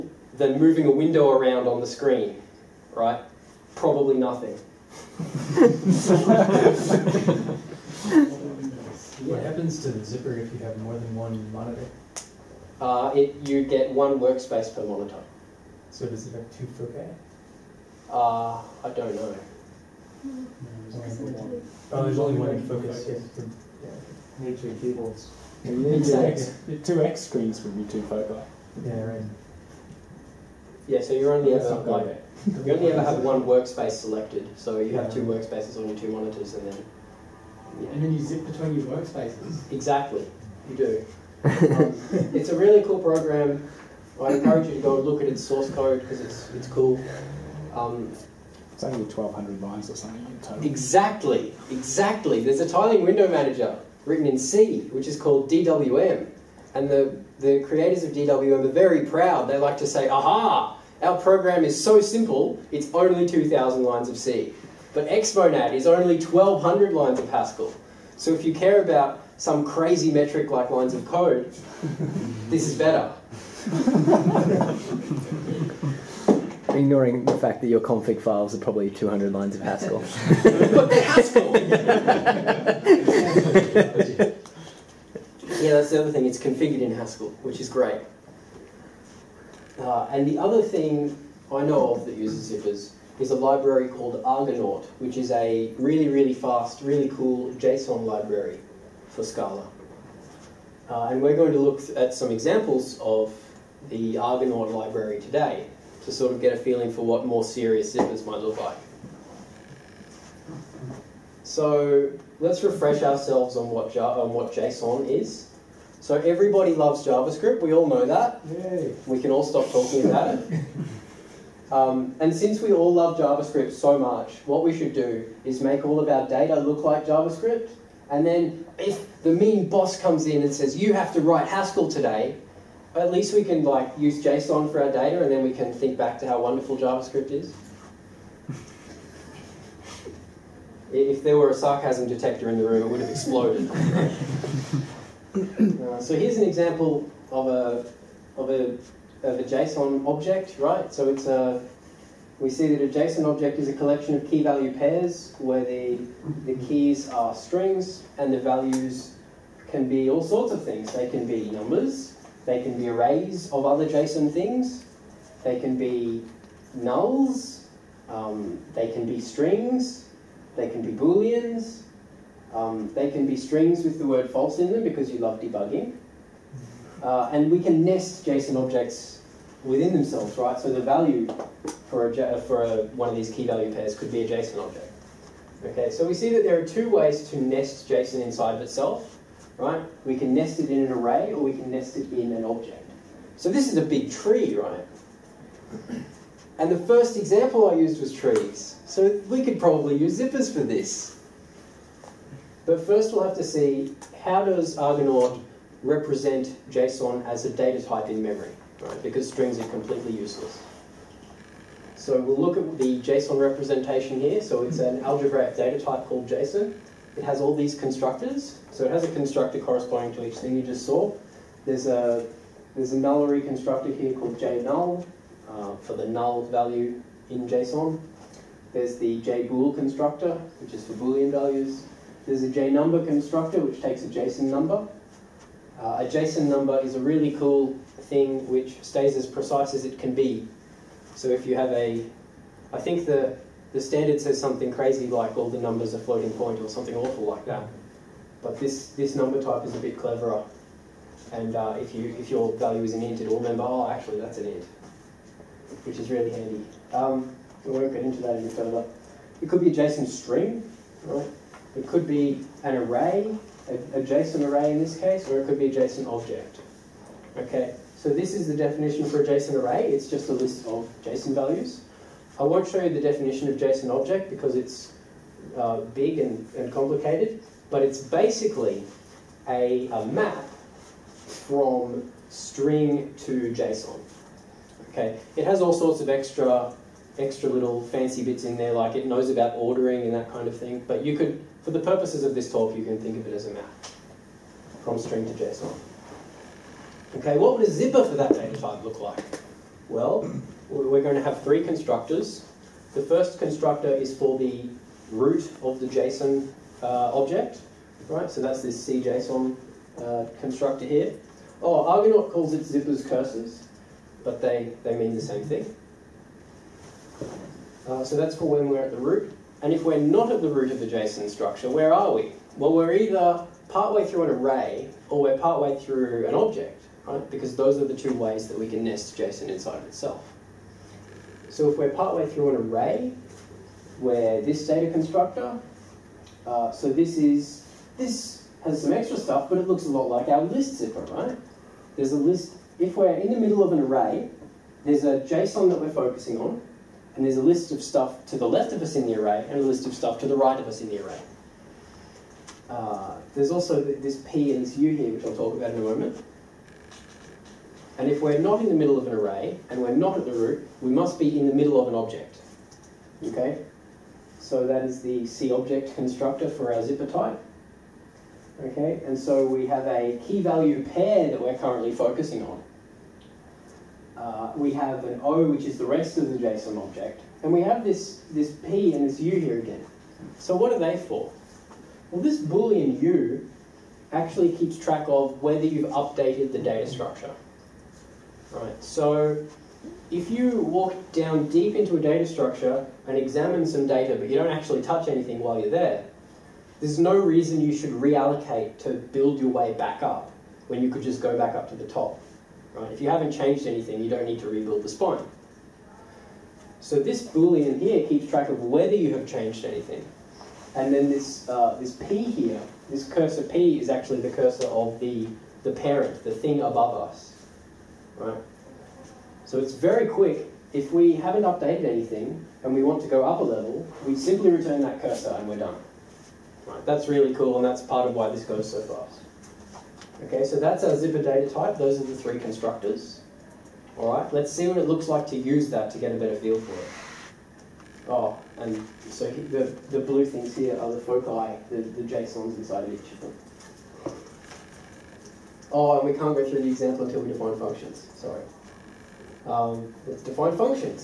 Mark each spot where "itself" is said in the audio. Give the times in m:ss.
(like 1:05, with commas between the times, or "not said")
3:08, 5:29.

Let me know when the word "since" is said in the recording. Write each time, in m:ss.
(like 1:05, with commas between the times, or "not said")
2:02.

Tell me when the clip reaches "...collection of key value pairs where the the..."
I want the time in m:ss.
2:33.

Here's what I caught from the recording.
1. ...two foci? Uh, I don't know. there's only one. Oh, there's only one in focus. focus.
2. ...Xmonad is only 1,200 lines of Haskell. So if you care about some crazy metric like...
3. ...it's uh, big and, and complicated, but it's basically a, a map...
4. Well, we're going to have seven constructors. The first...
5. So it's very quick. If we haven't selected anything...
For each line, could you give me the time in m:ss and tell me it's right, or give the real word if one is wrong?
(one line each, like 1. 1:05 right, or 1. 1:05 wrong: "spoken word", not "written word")
1. 0:16 right
2. 1:05 right
3. 4:34 right
4. 4:59 wrong: "three", not "seven"
5. 6:59 wrong: "updated", not "selected".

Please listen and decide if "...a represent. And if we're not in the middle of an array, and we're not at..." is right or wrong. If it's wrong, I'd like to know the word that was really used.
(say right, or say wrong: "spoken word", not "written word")
wrong: "moment", not "represent".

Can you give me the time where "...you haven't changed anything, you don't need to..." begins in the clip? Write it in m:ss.
6:43.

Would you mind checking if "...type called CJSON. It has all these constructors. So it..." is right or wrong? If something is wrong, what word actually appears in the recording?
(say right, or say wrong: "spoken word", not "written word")
wrong: "JSON", not "CJSON".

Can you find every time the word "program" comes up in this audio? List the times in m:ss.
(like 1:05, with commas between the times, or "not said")
0:42, 1:01.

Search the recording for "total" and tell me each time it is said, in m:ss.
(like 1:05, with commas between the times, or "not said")
0:50.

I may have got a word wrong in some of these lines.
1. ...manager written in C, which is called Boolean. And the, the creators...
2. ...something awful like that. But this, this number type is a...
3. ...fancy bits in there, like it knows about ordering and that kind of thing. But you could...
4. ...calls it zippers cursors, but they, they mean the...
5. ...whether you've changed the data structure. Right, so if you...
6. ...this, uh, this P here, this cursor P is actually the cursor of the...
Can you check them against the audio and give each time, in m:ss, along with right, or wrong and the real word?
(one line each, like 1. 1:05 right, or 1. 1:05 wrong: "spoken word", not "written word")
1. 0:53 wrong: "DWM", not "Boolean"
2. 4:06 right
3. 4:47 right
4. 5:12 right
5. 6:25 wrong: "updated", not "changed"
6. 6:51 right.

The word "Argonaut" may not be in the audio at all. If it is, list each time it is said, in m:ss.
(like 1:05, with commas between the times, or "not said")
1:34, 1:44, 3:24, 5:11.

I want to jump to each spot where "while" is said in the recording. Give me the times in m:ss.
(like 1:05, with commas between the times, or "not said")
6:35.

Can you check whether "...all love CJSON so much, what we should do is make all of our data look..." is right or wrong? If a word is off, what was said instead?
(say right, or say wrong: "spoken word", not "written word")
wrong: "JavaScript", not "CJSON".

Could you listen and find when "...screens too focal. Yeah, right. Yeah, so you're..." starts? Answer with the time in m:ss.
0:27.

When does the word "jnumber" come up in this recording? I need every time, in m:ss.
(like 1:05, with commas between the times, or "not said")
3:52.